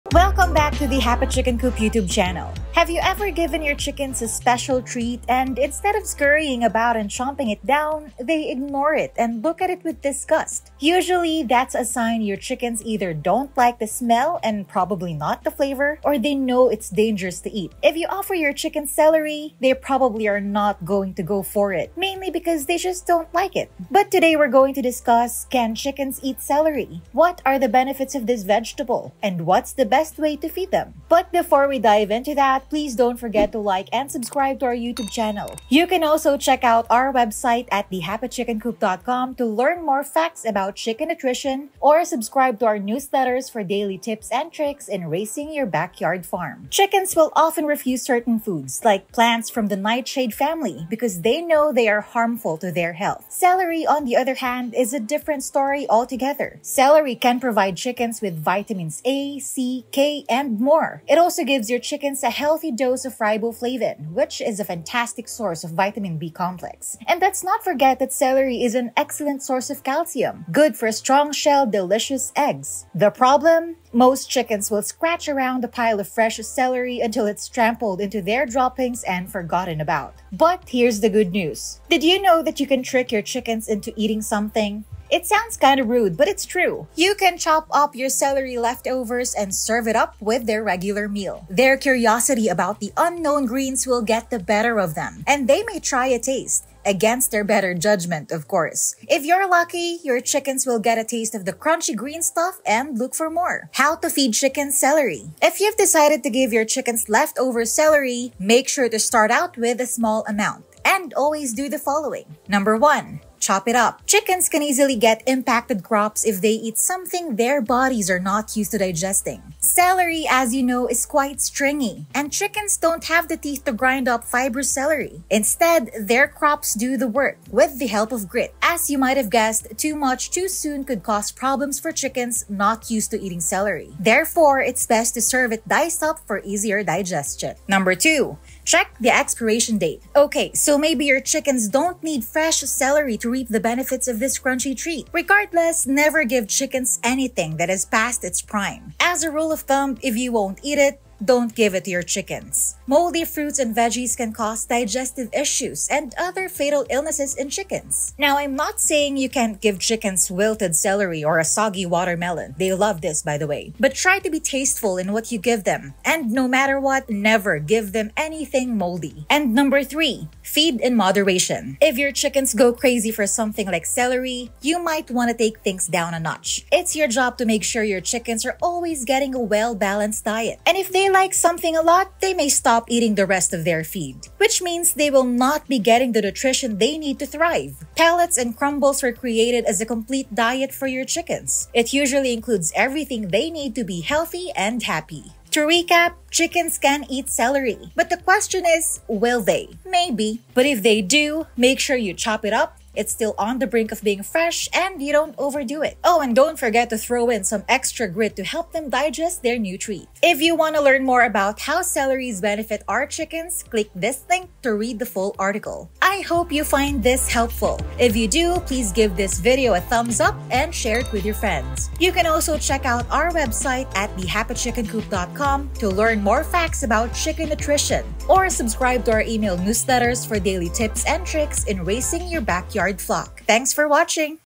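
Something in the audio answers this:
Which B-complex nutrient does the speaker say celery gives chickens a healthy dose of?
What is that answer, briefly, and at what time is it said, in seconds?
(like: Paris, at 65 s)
riboflavin, at 63 s.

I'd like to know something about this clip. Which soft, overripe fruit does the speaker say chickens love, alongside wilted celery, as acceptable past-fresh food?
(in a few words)
soggy watermelon.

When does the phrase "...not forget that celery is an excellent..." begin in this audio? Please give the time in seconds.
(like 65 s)
67 s.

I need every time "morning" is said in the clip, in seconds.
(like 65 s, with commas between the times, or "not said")
not said.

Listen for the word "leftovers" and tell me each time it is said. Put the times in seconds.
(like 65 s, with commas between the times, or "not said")
88 s, 107 s.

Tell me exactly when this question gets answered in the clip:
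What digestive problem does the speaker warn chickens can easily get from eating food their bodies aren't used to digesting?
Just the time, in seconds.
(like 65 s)
115 s.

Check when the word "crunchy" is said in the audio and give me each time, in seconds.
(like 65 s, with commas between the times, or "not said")
101 s, 144 s.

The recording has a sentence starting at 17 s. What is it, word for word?
If you offer your chicken celery, they probably are not going to go for it, mainly because they just don't like it.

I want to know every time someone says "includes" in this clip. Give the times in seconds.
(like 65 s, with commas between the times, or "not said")
192 s.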